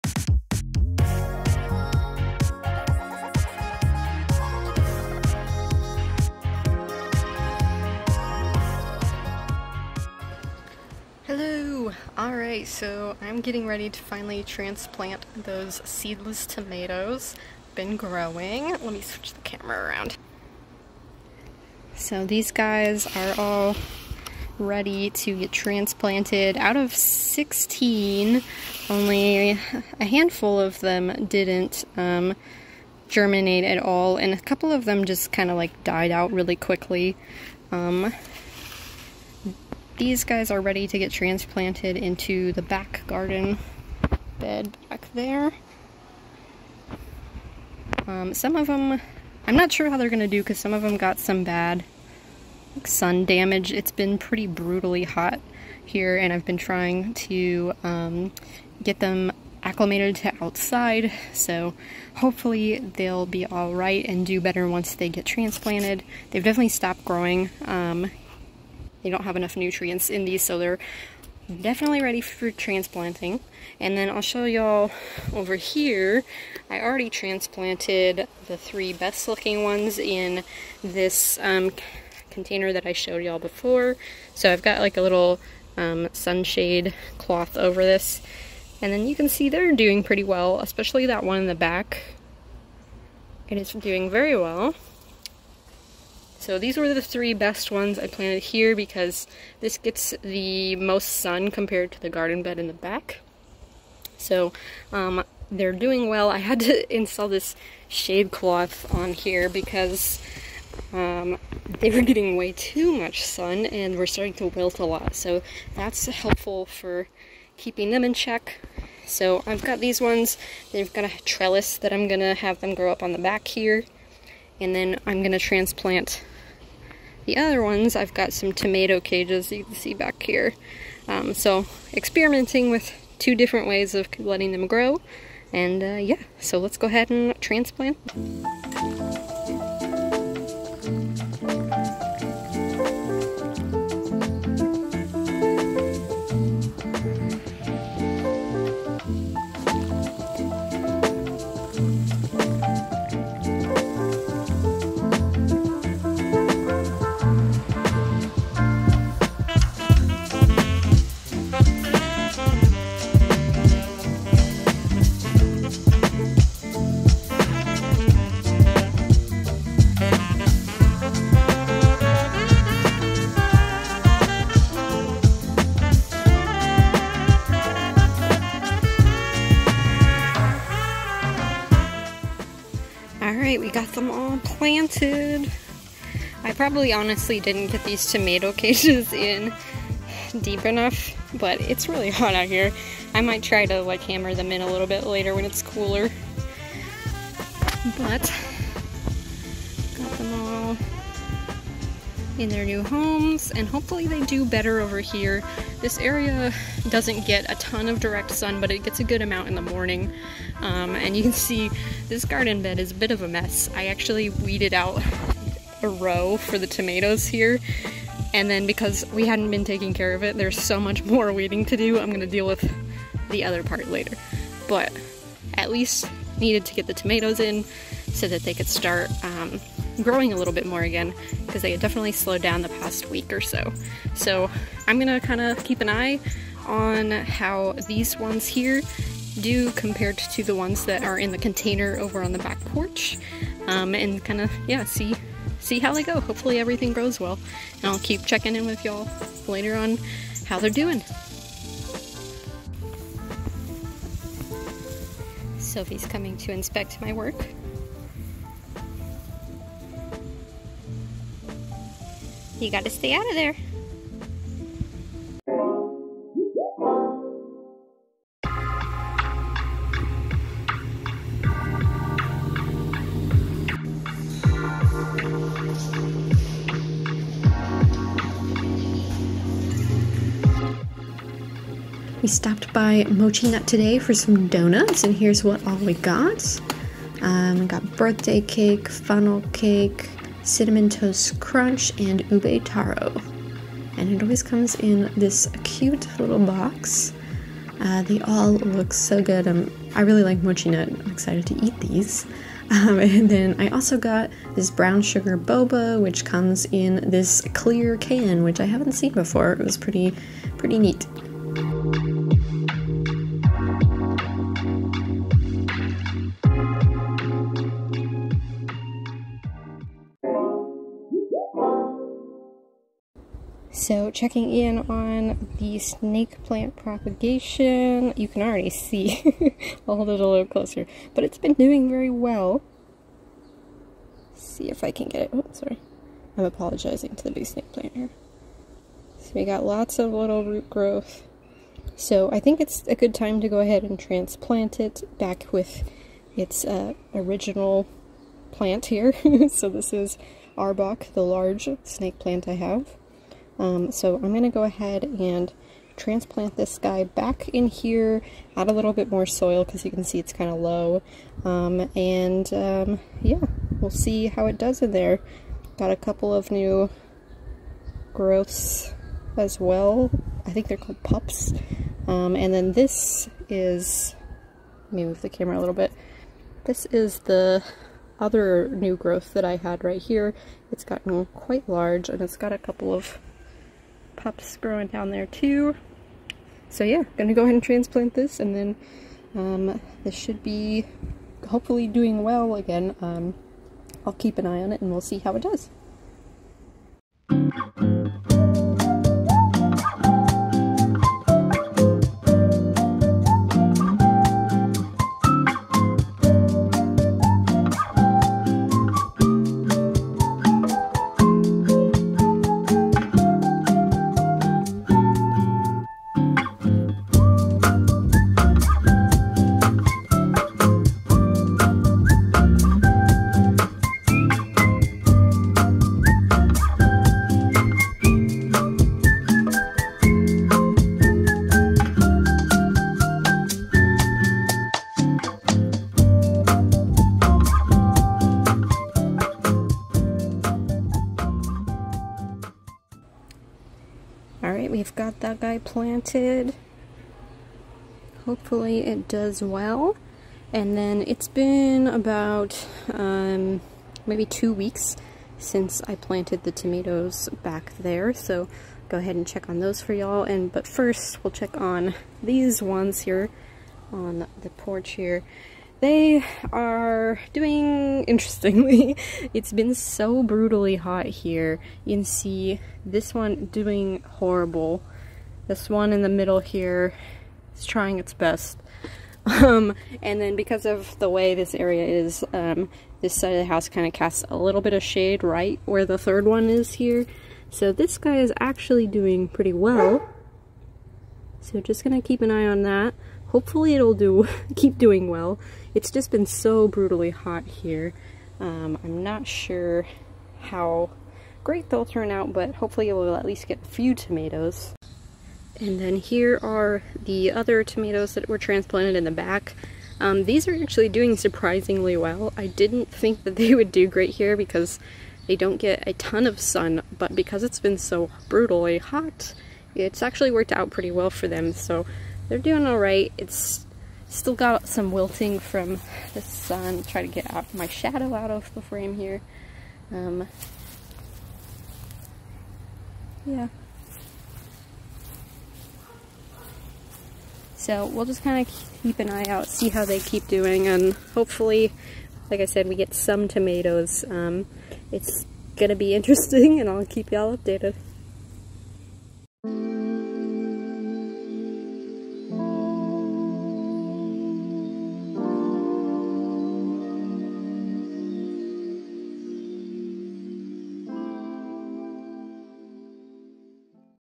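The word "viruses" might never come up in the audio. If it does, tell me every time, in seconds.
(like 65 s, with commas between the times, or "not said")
not said.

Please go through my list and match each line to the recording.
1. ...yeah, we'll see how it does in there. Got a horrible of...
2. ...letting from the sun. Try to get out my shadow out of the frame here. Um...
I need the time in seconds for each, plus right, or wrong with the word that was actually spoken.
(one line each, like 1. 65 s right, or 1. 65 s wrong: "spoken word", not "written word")
1. 363 s wrong: "couple", not "horrible"
2. 524 s wrong: "wilting", not "letting".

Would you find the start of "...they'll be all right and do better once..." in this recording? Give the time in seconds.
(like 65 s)
62 s.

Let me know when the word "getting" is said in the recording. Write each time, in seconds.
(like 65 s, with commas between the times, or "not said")
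13 s, 112 s.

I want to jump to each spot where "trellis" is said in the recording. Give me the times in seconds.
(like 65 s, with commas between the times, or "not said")
121 s.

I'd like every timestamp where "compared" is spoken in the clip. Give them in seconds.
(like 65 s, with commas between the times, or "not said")
101 s, 239 s.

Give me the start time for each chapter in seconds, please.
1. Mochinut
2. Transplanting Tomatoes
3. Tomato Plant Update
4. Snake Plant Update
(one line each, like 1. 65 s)
1. 265 s
2. 10 s
3. 455 s
4. 320 s.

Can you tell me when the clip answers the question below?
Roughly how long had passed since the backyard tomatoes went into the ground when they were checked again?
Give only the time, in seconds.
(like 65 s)
454 s.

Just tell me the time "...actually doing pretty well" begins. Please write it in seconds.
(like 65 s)
488 s.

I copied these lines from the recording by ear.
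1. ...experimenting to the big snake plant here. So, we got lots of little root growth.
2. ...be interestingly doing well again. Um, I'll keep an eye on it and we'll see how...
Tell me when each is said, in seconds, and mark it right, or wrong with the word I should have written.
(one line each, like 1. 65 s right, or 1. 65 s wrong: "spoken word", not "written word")
1. 336 s wrong: "apologizing", not "experimenting"
2. 390 s wrong: "hopefully", not "interestingly".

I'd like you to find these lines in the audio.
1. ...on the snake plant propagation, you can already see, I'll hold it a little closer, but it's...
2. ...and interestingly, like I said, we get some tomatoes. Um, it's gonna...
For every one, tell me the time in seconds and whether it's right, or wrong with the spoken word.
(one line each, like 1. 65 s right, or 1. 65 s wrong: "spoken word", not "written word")
1. 324 s right
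2. 540 s wrong: "hopefully", not "interestingly".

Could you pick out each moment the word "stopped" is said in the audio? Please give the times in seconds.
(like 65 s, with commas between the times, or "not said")
66 s, 282 s.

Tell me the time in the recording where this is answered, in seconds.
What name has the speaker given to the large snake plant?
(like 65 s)
350 s.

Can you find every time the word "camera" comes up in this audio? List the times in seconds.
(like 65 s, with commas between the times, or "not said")
19 s, 375 s.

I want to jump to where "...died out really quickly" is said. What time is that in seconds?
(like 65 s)
35 s.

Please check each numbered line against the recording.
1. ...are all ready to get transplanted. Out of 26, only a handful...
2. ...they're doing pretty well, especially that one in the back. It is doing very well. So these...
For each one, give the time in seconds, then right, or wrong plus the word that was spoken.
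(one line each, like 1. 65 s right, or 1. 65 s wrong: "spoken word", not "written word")
1. 23 s wrong: "16", not "26"
2. 89 s right.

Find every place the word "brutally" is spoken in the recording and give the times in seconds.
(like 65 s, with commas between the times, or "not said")
54 s, 470 s, 496 s, 518 s.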